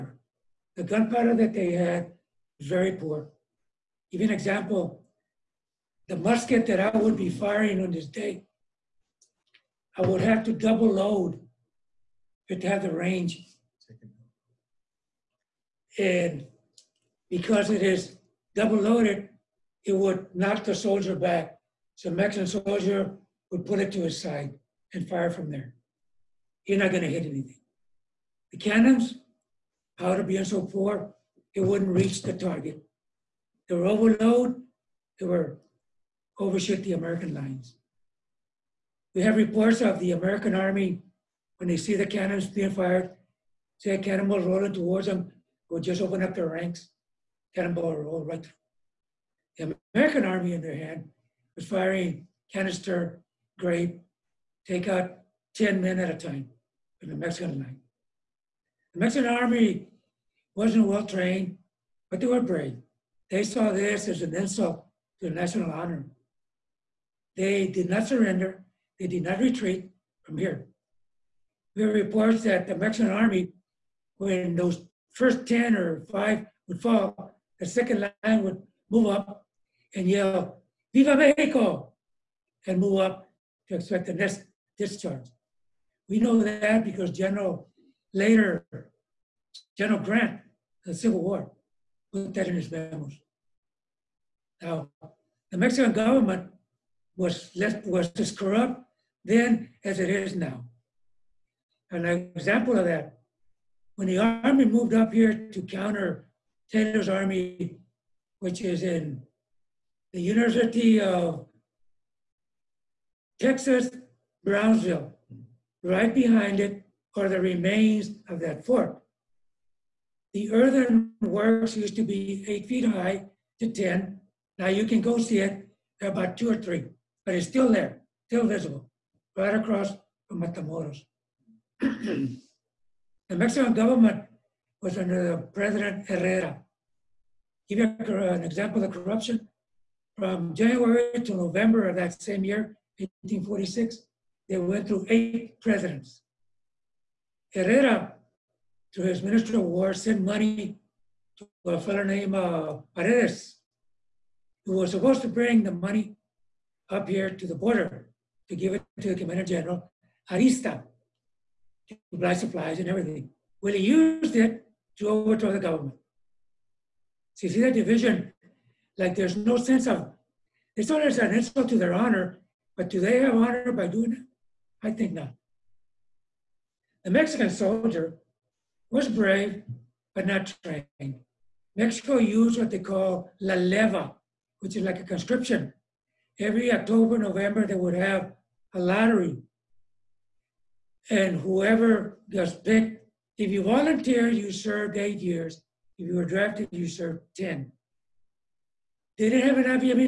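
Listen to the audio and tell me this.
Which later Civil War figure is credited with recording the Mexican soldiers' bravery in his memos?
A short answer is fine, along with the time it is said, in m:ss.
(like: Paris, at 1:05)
General Grant, at 1:29.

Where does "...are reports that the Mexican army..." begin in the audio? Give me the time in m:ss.
1:11.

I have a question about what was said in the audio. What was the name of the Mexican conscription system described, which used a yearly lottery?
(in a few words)
la leva.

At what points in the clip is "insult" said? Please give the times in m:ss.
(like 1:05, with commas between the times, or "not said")
1:04, 2:51.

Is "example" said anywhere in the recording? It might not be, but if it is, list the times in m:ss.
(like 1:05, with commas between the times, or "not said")
0:04, 1:42, 2:18.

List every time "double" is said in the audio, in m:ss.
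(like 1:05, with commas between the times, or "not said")
0:10, 0:18.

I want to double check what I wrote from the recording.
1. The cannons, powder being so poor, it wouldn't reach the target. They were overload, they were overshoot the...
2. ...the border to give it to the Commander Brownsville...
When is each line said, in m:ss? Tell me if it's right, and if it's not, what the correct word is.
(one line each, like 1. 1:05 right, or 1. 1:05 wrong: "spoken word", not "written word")
1. 0:28 right
2. 2:37 wrong: "General", not "Brownsville".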